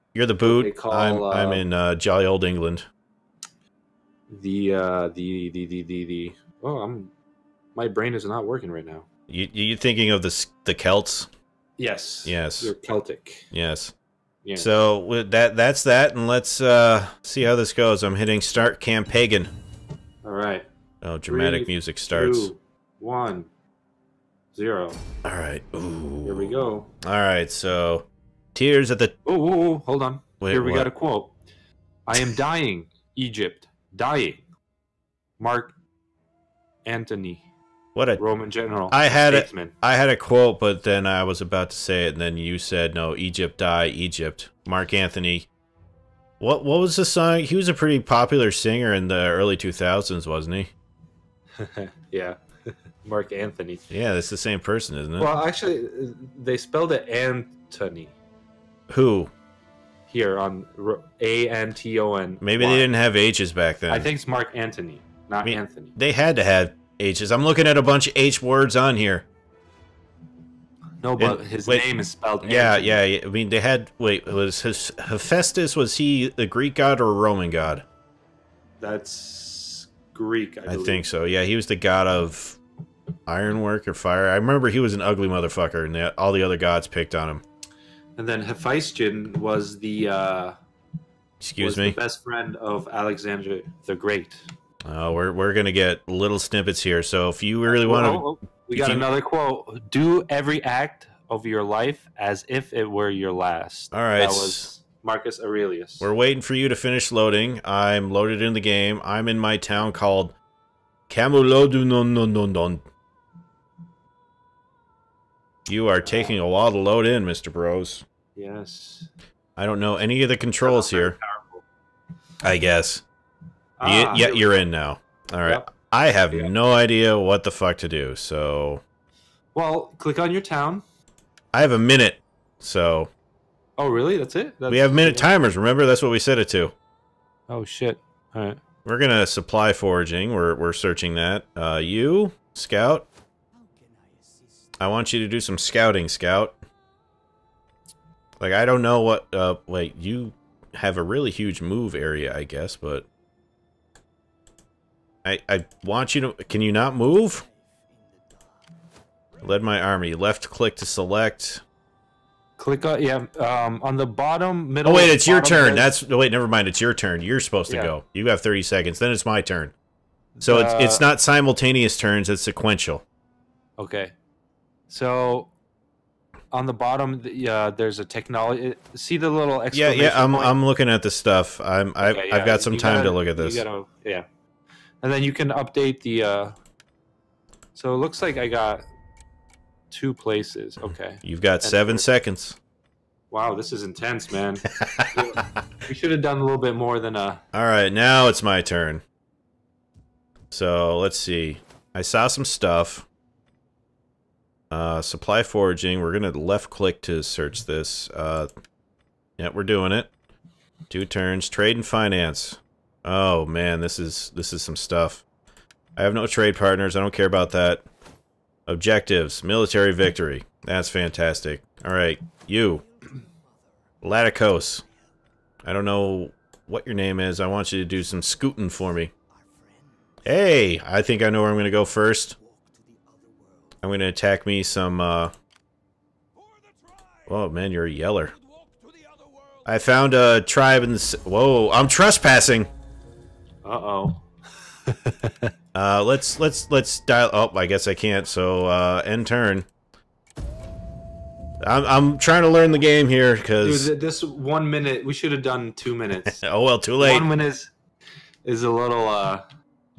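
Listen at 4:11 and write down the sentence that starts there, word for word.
I'm I'm trying to learn the game here because this one minute we should have done two minutes.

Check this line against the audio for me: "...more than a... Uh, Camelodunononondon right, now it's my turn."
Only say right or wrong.
wrong.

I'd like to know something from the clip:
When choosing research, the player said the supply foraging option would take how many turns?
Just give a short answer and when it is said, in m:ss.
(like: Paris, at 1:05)
2, at 3:30.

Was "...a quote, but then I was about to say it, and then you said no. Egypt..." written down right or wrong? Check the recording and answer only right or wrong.
right.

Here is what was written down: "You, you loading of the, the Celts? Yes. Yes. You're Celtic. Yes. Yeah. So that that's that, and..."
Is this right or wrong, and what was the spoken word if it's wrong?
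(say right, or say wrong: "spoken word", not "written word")
wrong: "thinking", not "loading".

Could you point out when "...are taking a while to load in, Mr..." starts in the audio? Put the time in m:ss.
1:55.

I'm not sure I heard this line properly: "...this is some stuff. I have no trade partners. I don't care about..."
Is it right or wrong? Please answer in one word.
right.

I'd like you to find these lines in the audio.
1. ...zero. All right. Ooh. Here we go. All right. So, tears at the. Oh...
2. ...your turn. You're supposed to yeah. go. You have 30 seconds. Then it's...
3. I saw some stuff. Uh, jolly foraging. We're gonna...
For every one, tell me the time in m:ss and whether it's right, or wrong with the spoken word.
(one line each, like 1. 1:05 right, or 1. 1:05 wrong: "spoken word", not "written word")
1. 0:24 right
2. 2:46 right
3. 3:21 wrong: "supply", not "jolly".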